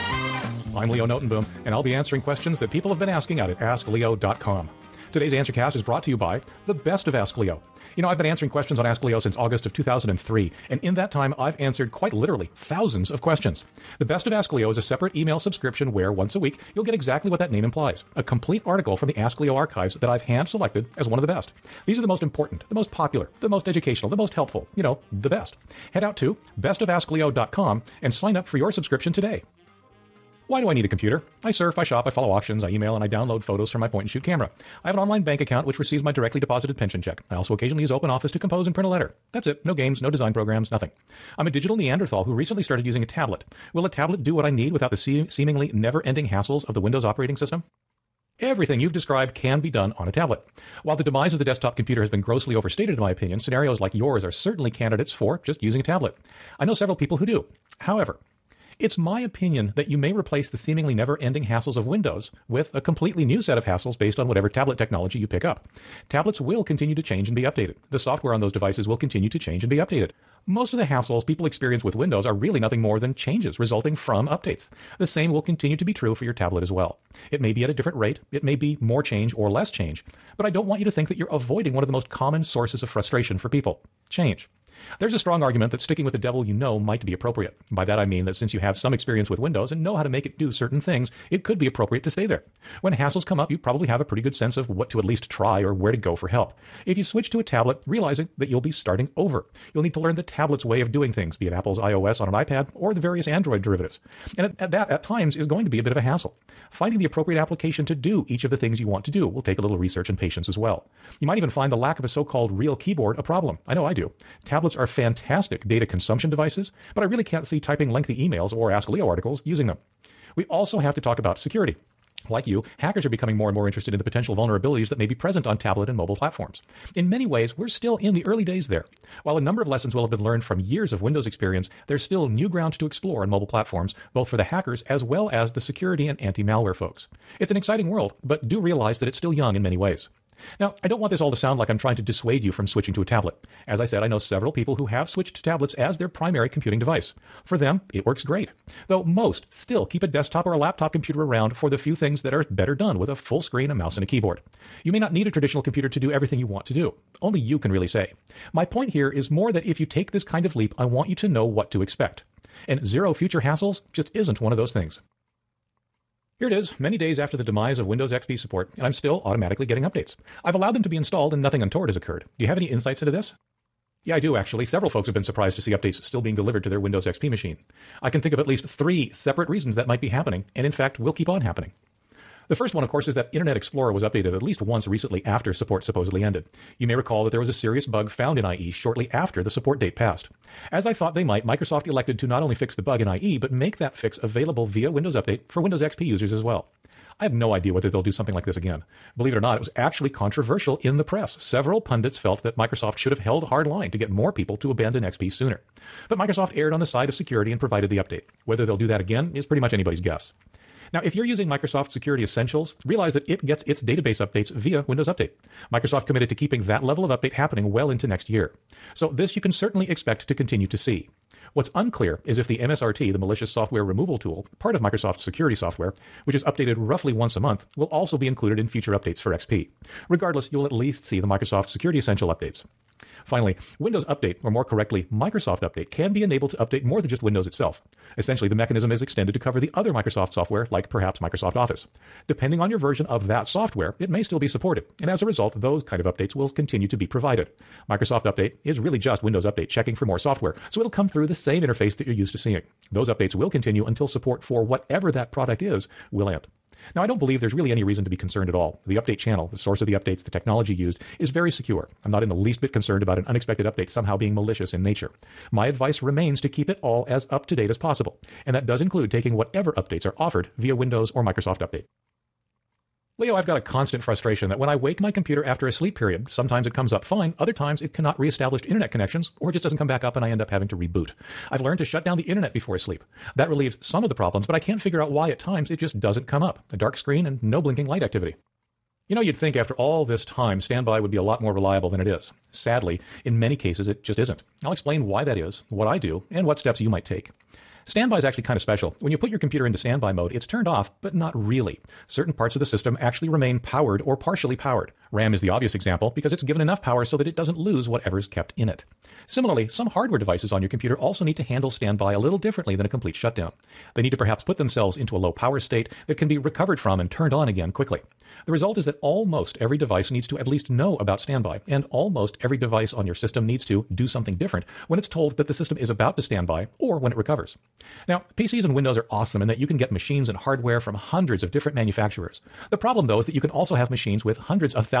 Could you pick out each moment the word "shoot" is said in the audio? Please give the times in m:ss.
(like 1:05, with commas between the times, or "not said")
0:34.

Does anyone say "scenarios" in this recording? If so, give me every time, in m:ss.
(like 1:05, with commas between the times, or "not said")
0:53.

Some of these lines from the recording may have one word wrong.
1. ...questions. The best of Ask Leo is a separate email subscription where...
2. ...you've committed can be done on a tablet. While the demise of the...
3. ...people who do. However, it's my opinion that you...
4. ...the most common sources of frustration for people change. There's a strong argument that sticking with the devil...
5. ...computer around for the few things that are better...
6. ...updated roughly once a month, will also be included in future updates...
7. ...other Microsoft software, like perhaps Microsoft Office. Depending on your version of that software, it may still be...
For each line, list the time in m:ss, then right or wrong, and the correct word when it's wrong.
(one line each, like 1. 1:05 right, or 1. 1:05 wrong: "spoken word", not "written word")
1. 0:13 right
2. 0:48 wrong: "described", not "committed"
3. 0:56 right
4. 1:21 right
5. 2:30 right
6. 3:46 right
7. 3:59 right.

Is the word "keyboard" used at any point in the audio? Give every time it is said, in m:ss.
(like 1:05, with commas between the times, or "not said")
1:52, 2:34.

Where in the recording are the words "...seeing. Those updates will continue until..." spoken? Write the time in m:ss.
4:12.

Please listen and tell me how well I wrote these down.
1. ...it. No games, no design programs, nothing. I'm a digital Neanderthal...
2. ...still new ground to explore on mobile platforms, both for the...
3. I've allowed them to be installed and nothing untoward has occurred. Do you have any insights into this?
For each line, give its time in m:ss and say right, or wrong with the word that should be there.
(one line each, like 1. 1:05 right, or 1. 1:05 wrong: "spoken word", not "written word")
1. 0:39 right
2. 2:12 right
3. 2:50 right.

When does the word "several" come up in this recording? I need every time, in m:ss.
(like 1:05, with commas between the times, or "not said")
0:56, 2:24, 2:54, 3:21.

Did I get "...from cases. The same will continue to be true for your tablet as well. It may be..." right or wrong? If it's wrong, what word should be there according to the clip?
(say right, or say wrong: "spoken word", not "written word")
wrong: "updates", not "cases".